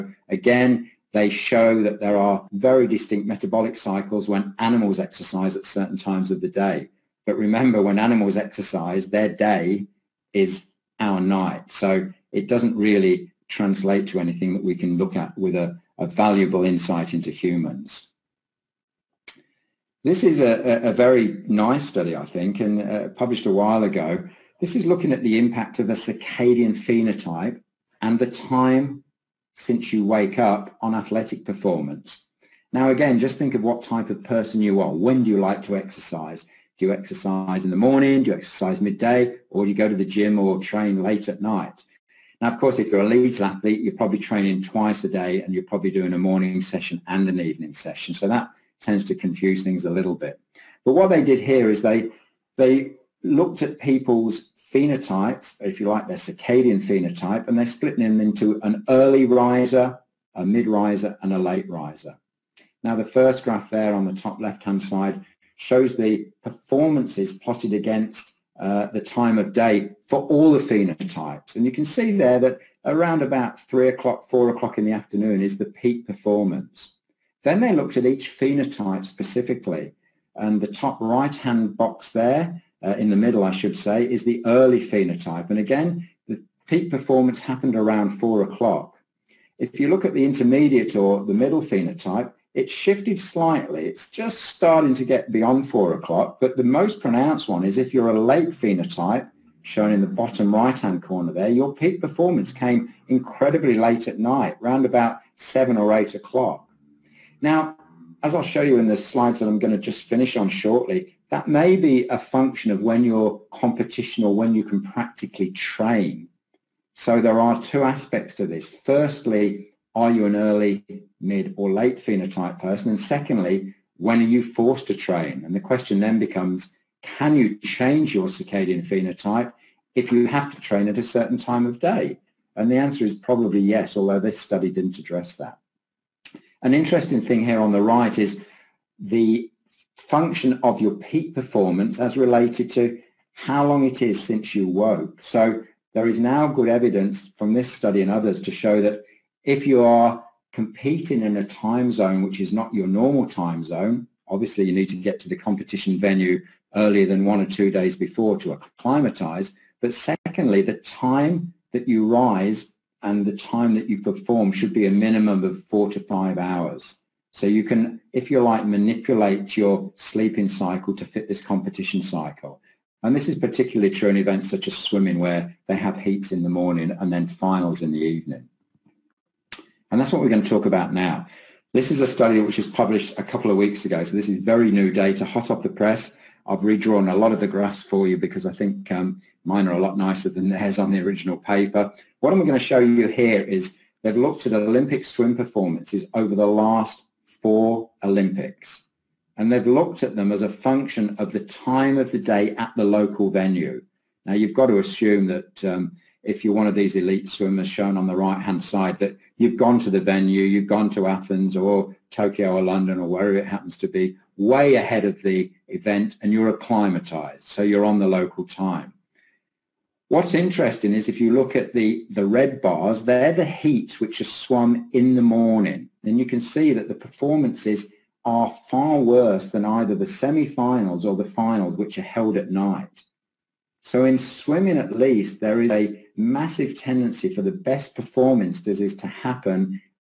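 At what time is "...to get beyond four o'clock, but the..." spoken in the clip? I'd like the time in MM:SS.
01:34.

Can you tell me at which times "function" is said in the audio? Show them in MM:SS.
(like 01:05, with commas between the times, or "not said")
01:52, 02:19, 03:20.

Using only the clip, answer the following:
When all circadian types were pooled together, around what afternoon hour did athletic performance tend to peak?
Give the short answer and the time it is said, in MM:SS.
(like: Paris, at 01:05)
3 or 4 o'clock, at 01:13.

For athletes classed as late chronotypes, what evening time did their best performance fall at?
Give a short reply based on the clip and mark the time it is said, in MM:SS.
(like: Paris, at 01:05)
7 or 8 o'clock, at 01:45.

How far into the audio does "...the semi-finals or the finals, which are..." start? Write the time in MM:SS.
03:49.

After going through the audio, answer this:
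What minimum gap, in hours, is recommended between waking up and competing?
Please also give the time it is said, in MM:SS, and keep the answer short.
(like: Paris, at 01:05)
4 to 5 hours, at 02:45.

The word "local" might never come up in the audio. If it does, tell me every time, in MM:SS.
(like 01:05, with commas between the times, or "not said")
03:22, 03:38.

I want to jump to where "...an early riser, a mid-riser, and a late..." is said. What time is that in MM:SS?
00:58.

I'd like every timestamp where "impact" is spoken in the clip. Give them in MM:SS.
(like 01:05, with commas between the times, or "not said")
00:25.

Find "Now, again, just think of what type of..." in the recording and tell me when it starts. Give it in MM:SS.
00:32.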